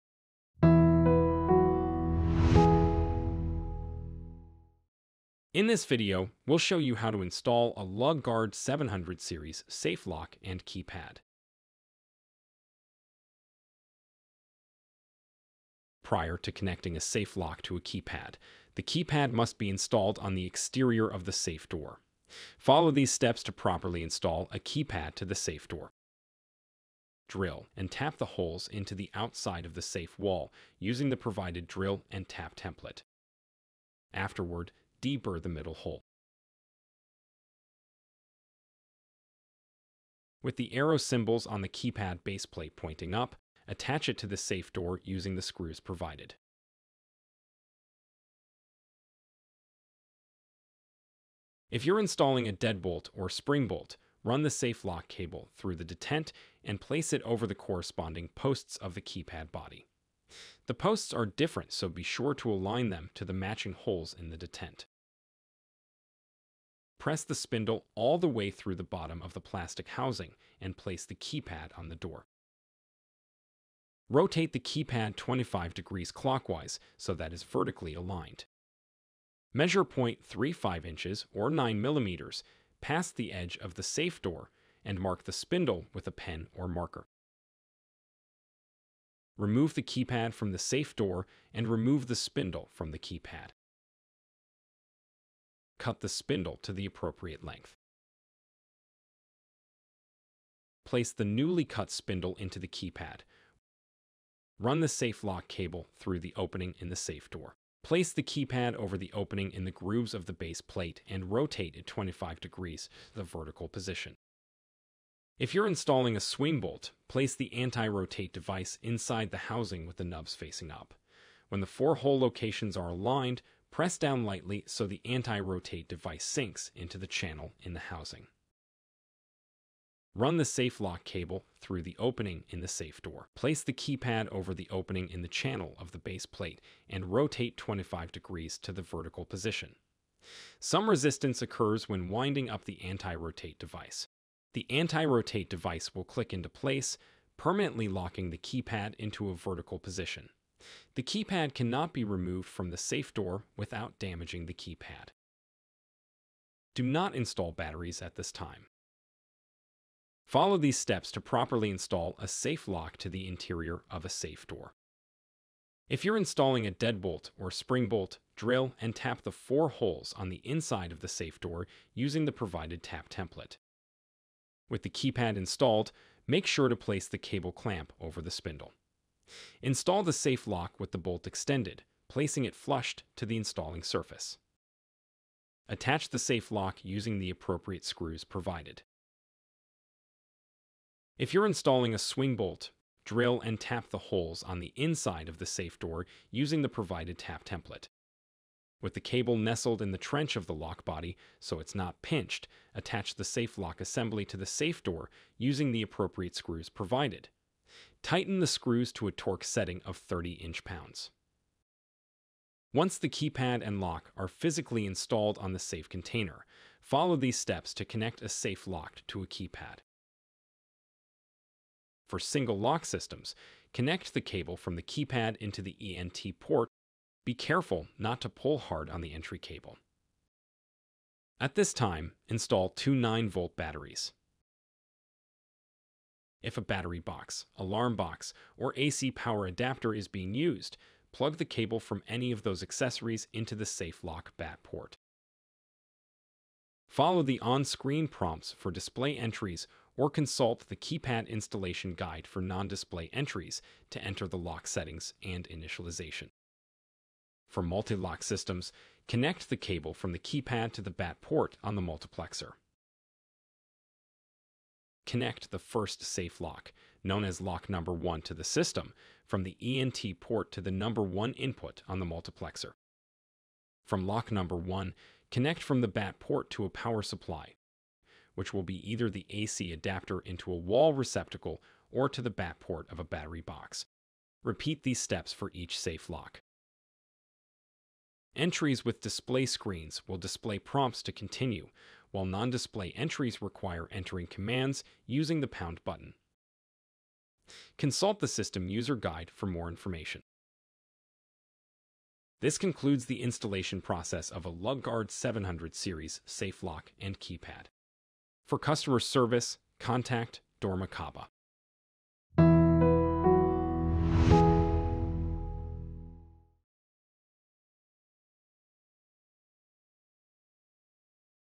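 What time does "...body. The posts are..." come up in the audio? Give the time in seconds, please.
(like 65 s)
59 s.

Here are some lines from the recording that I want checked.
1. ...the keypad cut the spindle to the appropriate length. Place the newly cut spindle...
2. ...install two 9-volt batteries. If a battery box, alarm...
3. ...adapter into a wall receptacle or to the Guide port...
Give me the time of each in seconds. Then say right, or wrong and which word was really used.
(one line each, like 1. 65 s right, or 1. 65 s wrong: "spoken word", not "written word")
1. 92 s right
2. 232 s right
3. 279 s wrong: "BAT", not "Guide".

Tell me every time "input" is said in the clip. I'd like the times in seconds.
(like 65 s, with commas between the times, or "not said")
271 s.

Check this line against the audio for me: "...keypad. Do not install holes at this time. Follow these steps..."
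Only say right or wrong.
wrong.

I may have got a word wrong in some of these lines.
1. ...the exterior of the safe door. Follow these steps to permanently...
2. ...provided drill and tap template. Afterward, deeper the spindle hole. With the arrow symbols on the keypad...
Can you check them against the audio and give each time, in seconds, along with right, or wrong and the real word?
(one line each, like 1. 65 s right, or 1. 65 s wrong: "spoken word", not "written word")
1. 20 s wrong: "properly", not "permanently"
2. 31 s wrong: "middle", not "spindle".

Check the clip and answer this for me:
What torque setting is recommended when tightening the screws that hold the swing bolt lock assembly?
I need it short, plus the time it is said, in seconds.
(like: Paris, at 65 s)
30 inch-pounds, at 209 s.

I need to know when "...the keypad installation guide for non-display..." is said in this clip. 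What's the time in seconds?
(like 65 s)
250 s.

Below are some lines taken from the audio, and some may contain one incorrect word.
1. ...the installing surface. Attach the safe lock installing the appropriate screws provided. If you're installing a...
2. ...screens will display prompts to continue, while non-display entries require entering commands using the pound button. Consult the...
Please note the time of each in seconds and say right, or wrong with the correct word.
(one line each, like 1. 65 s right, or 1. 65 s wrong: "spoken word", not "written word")
1. 183 s wrong: "using", not "installing"
2. 289 s right.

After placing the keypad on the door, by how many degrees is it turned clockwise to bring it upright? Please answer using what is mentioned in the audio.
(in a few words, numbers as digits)
25 degrees.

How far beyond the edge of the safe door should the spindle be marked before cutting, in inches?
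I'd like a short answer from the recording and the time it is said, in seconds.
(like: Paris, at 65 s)
0.35 inches, at 79 s.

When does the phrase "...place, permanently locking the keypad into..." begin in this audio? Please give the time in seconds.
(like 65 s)
146 s.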